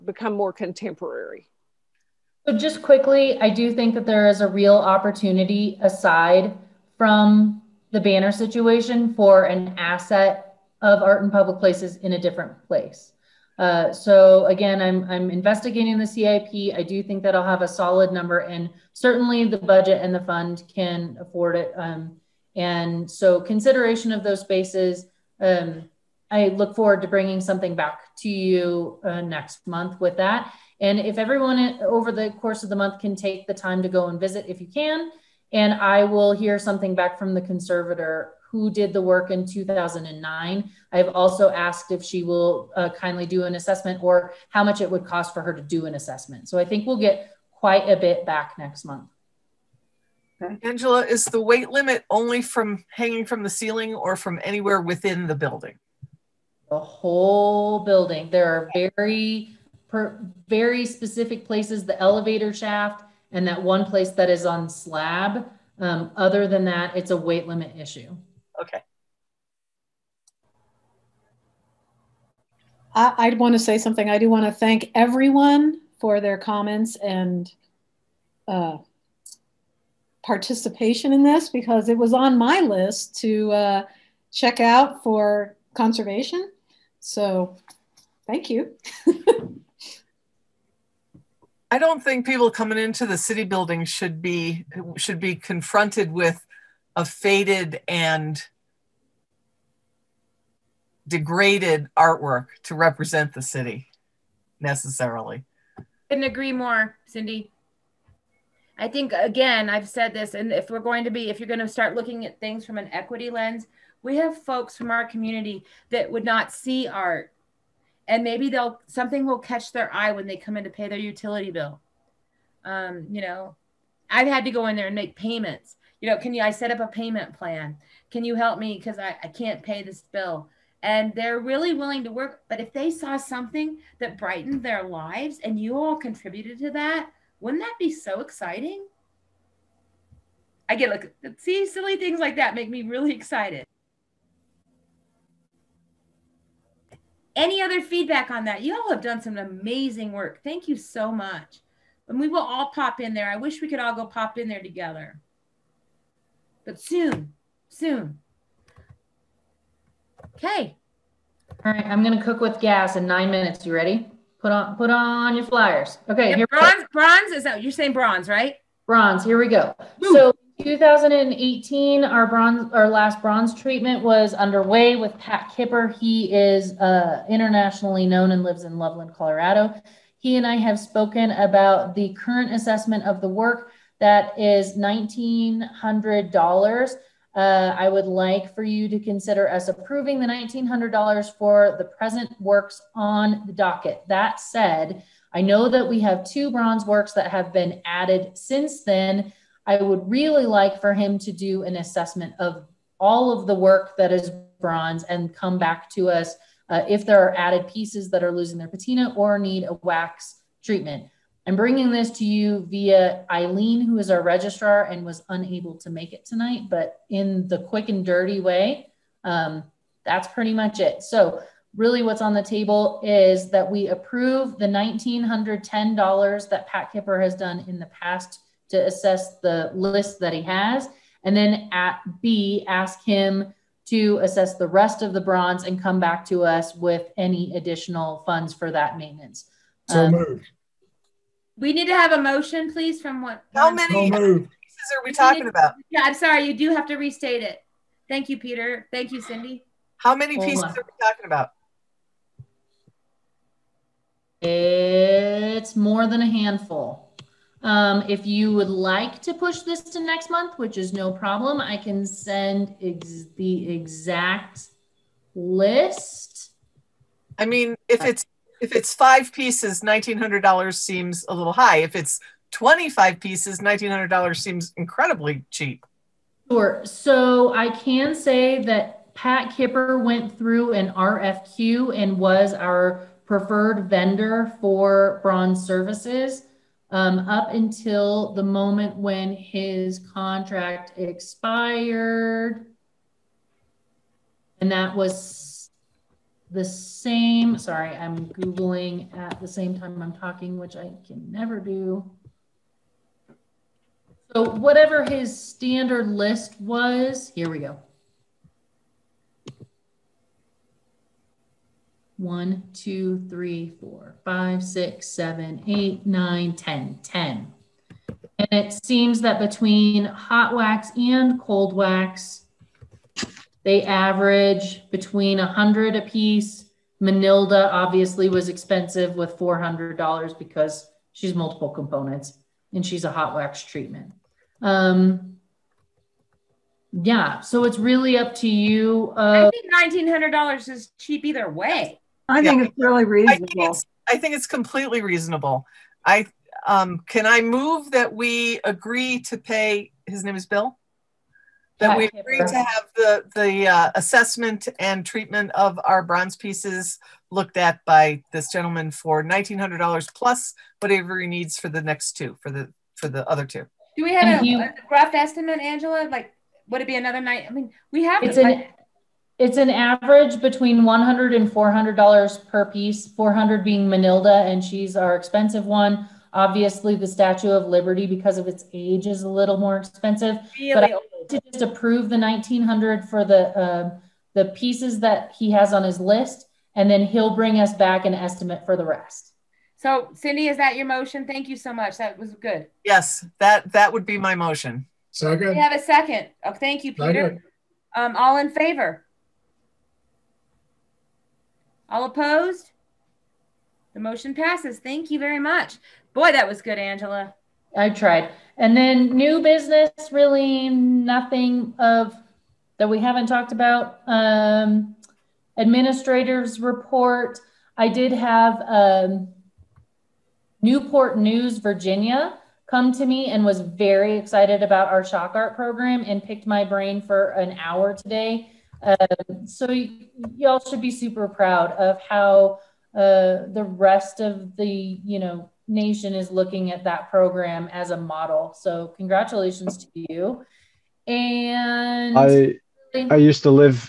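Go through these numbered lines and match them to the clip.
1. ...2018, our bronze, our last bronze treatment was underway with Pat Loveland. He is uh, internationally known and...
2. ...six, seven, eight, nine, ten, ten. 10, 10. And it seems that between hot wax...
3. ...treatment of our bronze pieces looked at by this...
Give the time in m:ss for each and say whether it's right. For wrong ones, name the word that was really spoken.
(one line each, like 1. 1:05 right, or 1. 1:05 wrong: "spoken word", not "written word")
1. 2:50 wrong: "Kipper", not "Loveland"
2. 5:14 right
3. 5:55 right.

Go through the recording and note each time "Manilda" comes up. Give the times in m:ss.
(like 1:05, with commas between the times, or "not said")
5:27, 6:13.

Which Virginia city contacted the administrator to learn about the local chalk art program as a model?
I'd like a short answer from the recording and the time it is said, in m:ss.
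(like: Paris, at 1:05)
Newport News, at 7:00.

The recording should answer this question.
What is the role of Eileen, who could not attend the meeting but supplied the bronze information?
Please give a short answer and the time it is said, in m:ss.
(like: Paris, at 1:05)
Registrar, at 3:34.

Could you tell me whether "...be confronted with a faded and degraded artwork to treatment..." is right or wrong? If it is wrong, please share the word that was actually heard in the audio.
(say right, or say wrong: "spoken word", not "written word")
wrong: "represent", not "treatment".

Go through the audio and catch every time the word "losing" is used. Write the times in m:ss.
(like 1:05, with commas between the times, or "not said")
3:28.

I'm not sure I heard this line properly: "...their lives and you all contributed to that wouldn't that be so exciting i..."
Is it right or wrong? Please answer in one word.
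right.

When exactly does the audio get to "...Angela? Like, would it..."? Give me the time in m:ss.
6:05.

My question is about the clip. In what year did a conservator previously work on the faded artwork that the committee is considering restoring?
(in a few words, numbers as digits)
2009.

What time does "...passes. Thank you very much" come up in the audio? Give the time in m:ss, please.
6:44.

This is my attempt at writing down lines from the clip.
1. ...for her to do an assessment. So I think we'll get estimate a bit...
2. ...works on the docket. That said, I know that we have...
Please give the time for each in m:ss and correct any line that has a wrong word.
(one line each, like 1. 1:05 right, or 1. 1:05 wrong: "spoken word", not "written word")
1. 0:45 wrong: "quite", not "estimate"
2. 3:12 right.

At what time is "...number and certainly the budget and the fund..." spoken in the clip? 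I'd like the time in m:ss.
0:18.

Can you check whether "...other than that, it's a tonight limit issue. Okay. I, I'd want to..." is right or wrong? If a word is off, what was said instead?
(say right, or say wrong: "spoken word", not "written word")
wrong: "weight", not "tonight".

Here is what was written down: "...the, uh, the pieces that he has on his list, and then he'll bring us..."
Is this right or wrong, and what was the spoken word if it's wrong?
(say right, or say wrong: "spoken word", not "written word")
right.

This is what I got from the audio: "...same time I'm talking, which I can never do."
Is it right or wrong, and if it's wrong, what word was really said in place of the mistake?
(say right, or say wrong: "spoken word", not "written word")
right.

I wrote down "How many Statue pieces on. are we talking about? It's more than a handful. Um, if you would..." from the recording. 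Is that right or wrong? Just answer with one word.
wrong.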